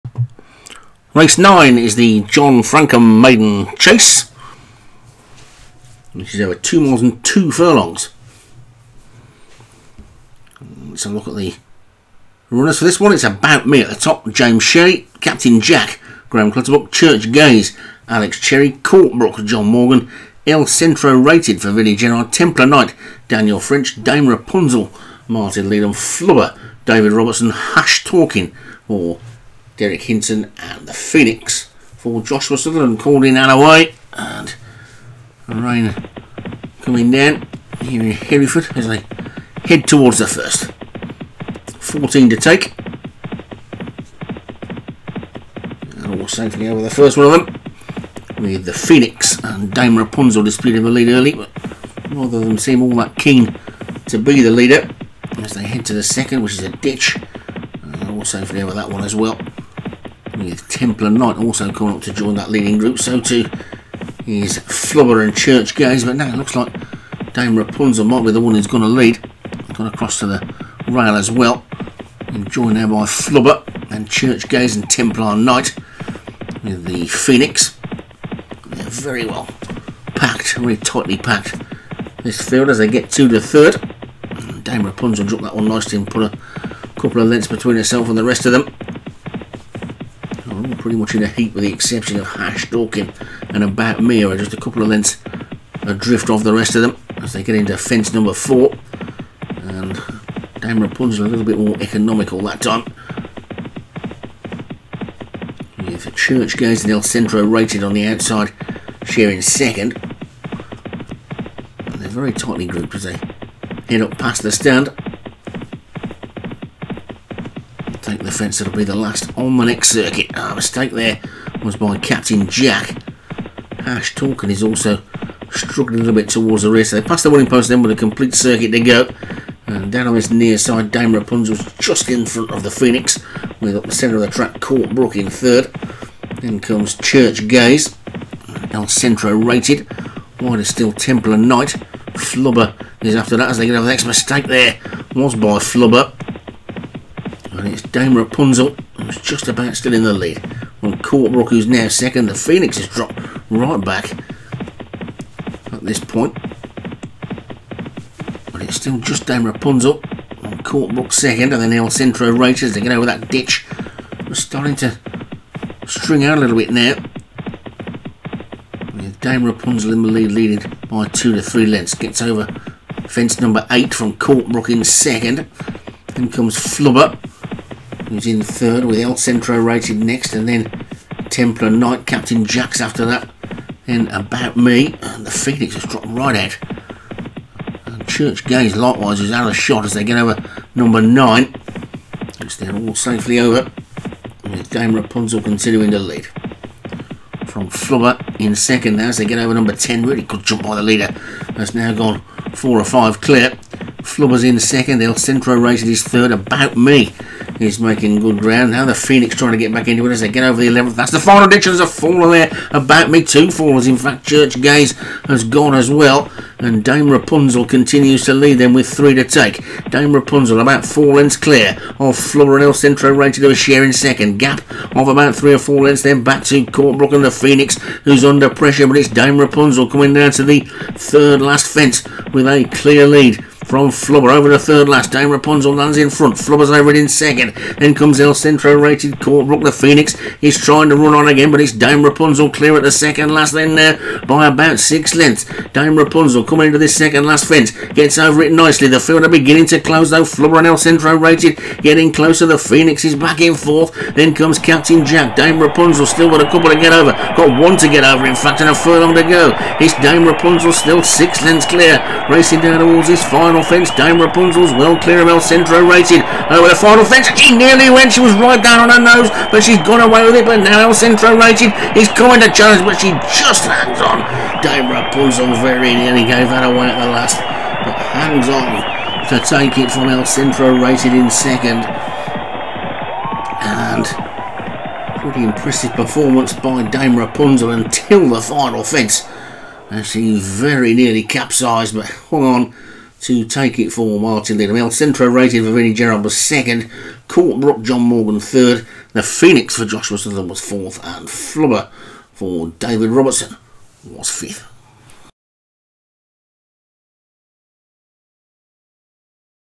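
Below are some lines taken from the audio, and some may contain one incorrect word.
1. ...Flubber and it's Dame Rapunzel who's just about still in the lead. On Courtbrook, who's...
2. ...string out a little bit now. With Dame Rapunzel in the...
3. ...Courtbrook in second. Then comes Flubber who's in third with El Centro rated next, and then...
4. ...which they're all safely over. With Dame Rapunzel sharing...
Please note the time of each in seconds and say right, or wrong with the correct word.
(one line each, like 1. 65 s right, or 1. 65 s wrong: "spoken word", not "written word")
1. 145 s right
2. 165 s right
3. 174 s right
4. 192 s wrong: "continuing", not "sharing".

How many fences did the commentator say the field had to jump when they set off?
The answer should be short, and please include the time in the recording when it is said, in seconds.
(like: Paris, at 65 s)
14, at 41 s.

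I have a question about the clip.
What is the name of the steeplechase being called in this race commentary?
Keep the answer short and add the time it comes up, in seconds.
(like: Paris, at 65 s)
John Francome Maiden Chase, at 2 s.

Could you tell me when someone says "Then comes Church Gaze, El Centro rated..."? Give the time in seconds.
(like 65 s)
136 s.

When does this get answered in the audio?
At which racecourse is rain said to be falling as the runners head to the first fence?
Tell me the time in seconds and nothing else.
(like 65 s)
38 s.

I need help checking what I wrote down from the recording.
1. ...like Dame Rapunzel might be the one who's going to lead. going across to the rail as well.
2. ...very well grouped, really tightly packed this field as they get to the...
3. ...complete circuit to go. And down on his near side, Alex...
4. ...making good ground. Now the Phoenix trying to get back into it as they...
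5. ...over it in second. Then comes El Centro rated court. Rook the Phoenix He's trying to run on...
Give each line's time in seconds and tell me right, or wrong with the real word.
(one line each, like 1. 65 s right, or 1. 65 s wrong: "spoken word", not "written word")
1. 66 s right
2. 78 s wrong: "packed", not "grouped"
3. 127 s wrong: "Dame", not "Alex"
4. 207 s right
5. 236 s right.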